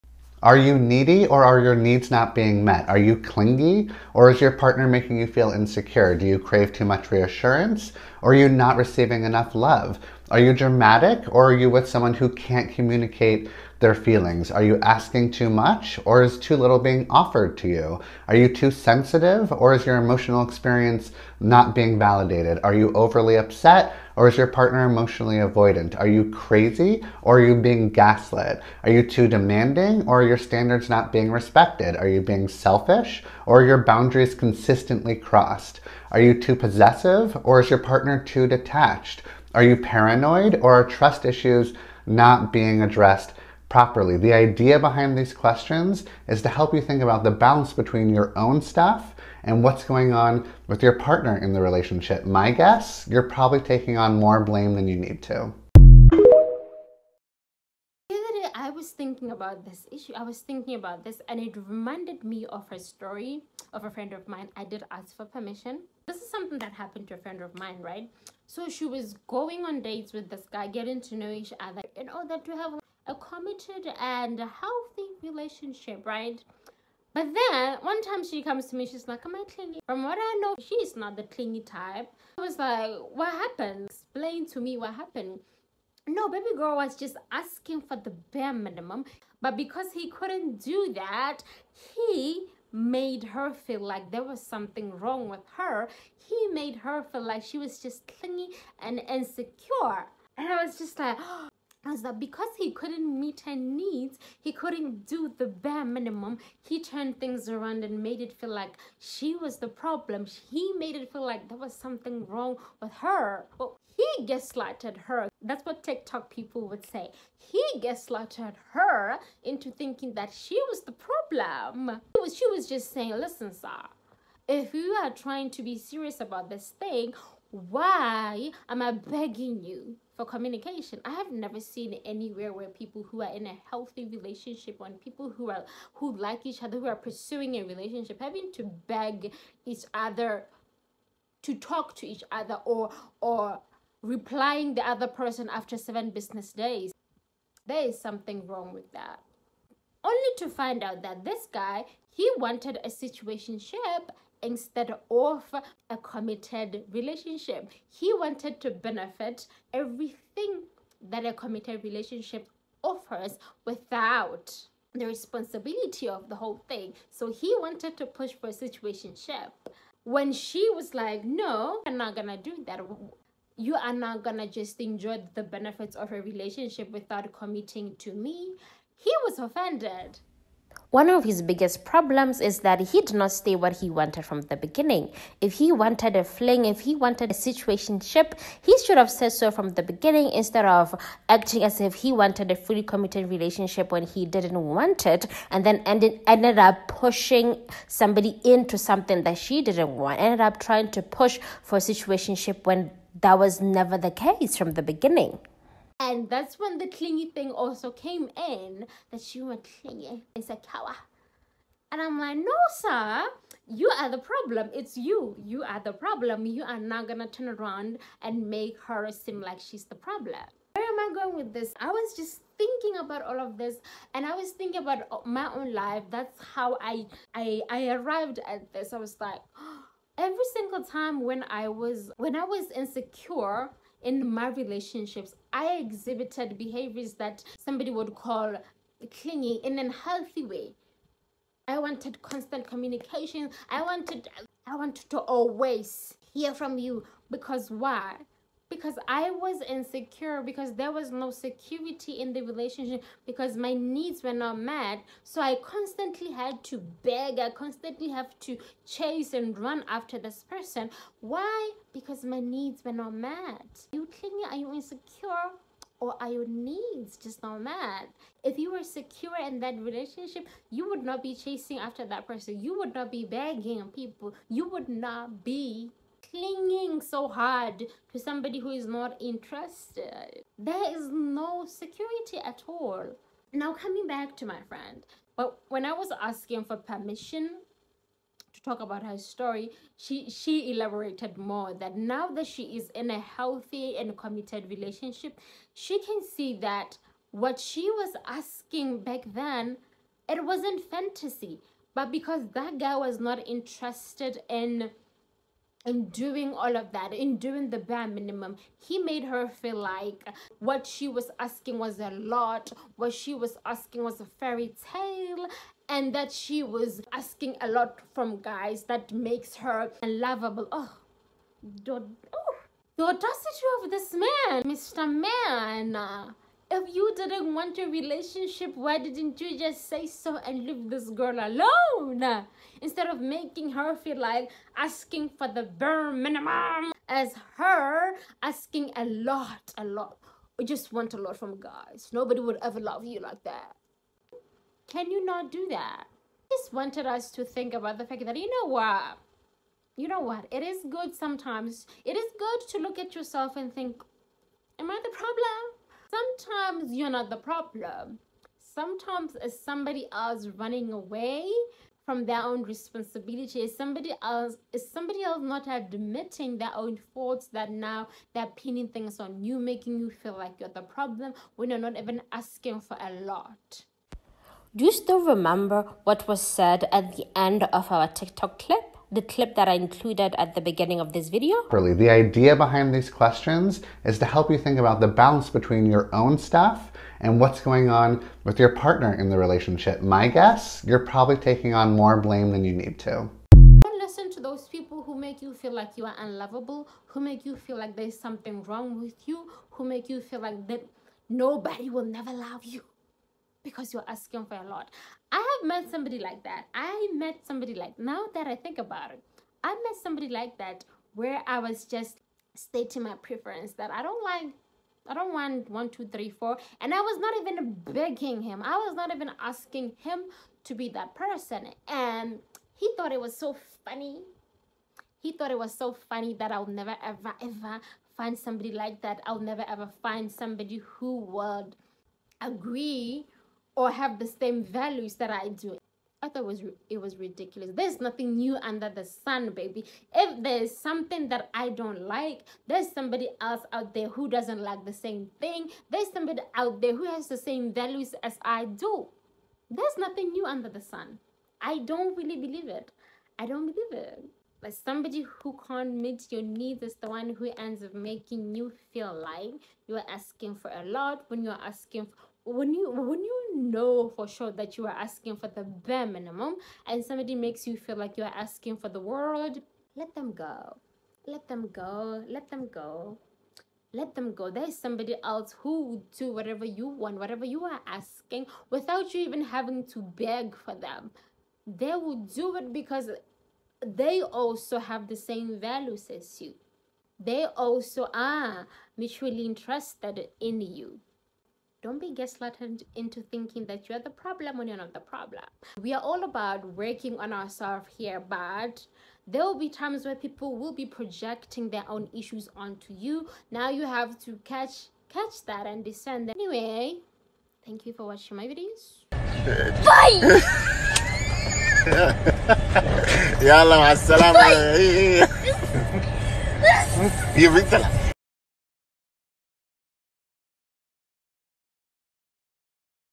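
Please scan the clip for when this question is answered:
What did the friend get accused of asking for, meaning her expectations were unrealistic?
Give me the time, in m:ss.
5:14.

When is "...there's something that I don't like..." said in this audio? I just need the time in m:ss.
7:20.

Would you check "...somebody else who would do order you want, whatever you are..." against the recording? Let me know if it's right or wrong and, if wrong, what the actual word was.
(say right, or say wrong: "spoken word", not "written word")
wrong: "whatever", not "order".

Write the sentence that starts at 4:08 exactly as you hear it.
because I was insecure because there was no security in the relationship because my needs were not met.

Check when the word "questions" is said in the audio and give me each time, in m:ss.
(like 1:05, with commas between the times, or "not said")
0:45, 6:23.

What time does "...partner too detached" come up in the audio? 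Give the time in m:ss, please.
0:37.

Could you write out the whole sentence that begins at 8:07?
They also are mutually interested in you.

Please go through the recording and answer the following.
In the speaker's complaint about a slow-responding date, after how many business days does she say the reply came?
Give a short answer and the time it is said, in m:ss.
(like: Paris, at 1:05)
7, at 2:25.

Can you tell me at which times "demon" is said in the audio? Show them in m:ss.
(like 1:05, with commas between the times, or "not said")
not said.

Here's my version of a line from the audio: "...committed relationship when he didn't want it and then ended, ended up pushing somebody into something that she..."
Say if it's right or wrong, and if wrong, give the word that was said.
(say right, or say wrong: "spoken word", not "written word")
right.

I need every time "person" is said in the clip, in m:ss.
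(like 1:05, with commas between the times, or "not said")
2:25, 4:20, 4:32, 7:01.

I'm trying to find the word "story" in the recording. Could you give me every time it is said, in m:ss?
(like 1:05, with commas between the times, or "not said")
1:02, 4:49.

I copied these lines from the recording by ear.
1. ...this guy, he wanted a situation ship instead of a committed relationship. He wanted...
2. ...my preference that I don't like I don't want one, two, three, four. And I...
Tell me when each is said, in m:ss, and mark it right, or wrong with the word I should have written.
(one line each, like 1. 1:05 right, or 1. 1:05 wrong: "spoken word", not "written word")
1. 2:31 right
2. 6:53 right.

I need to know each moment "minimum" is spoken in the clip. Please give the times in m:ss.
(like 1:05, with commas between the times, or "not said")
1:28, 1:45, 5:08, 5:36, 7:46.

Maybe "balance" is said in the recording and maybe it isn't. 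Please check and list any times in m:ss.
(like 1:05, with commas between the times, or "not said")
0:47, 6:25.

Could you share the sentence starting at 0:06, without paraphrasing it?
Do you crave too much reassurance or are you not receiving enough love?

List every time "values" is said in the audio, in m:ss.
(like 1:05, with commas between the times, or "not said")
7:14, 7:27, 8:05.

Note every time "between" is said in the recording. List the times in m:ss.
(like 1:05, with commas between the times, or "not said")
0:47, 6:25.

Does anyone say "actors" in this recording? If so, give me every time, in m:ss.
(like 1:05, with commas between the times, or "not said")
not said.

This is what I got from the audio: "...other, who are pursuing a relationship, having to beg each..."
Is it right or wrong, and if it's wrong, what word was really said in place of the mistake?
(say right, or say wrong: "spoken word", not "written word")
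right.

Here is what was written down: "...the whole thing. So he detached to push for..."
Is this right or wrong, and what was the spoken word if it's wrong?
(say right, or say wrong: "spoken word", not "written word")
wrong: "wanted", not "detached".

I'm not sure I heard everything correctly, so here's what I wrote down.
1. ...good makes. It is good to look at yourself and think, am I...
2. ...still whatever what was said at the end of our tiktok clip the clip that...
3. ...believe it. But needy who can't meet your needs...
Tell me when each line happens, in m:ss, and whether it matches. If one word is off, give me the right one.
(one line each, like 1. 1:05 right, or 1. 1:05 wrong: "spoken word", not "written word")
1. 5:50 wrong: "sometimes", not "makes"
2. 6:14 wrong: "remember", not "whatever"
3. 7:33 wrong: "somebody", not "needy".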